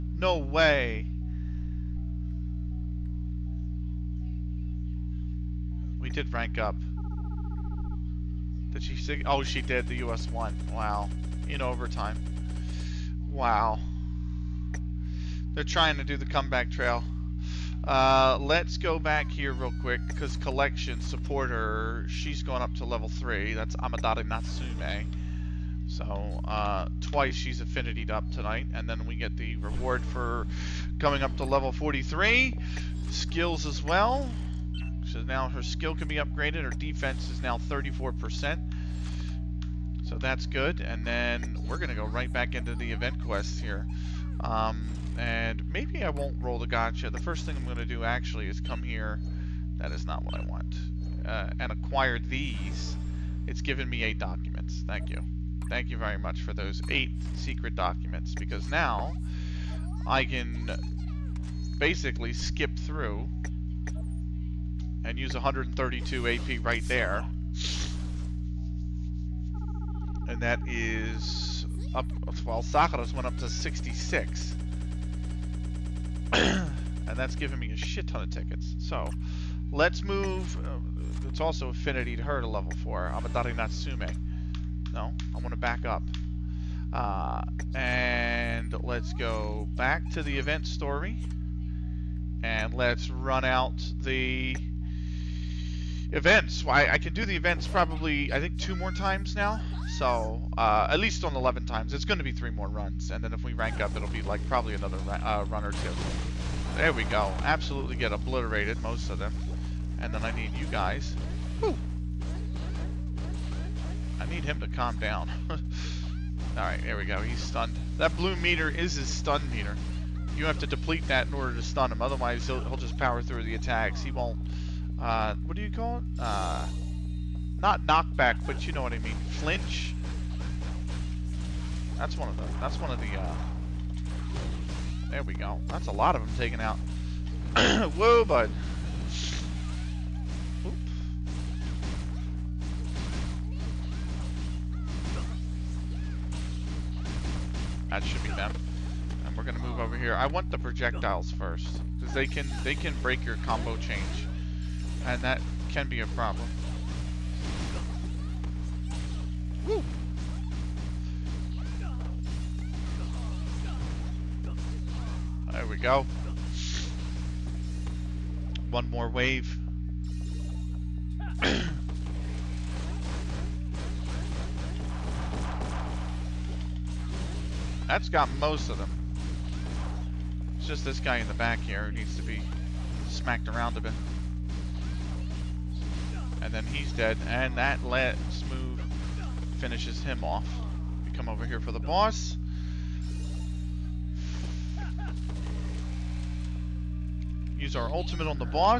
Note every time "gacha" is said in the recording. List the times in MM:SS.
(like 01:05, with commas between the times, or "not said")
00:46.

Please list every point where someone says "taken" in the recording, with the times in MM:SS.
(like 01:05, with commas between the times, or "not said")
02:16.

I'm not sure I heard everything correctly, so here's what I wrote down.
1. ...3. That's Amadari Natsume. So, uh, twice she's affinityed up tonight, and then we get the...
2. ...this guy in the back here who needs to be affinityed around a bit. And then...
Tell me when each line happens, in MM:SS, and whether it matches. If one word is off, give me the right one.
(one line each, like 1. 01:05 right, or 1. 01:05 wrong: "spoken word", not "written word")
1. 00:23 right
2. 03:00 wrong: "smacked", not "affinityed".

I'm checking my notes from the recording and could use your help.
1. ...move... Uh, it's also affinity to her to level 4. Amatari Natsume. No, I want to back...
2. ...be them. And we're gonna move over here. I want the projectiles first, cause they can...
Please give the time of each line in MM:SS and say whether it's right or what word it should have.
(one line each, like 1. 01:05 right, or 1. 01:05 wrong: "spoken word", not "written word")
1. 01:20 right
2. 02:28 right.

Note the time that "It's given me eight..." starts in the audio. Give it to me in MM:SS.
00:53.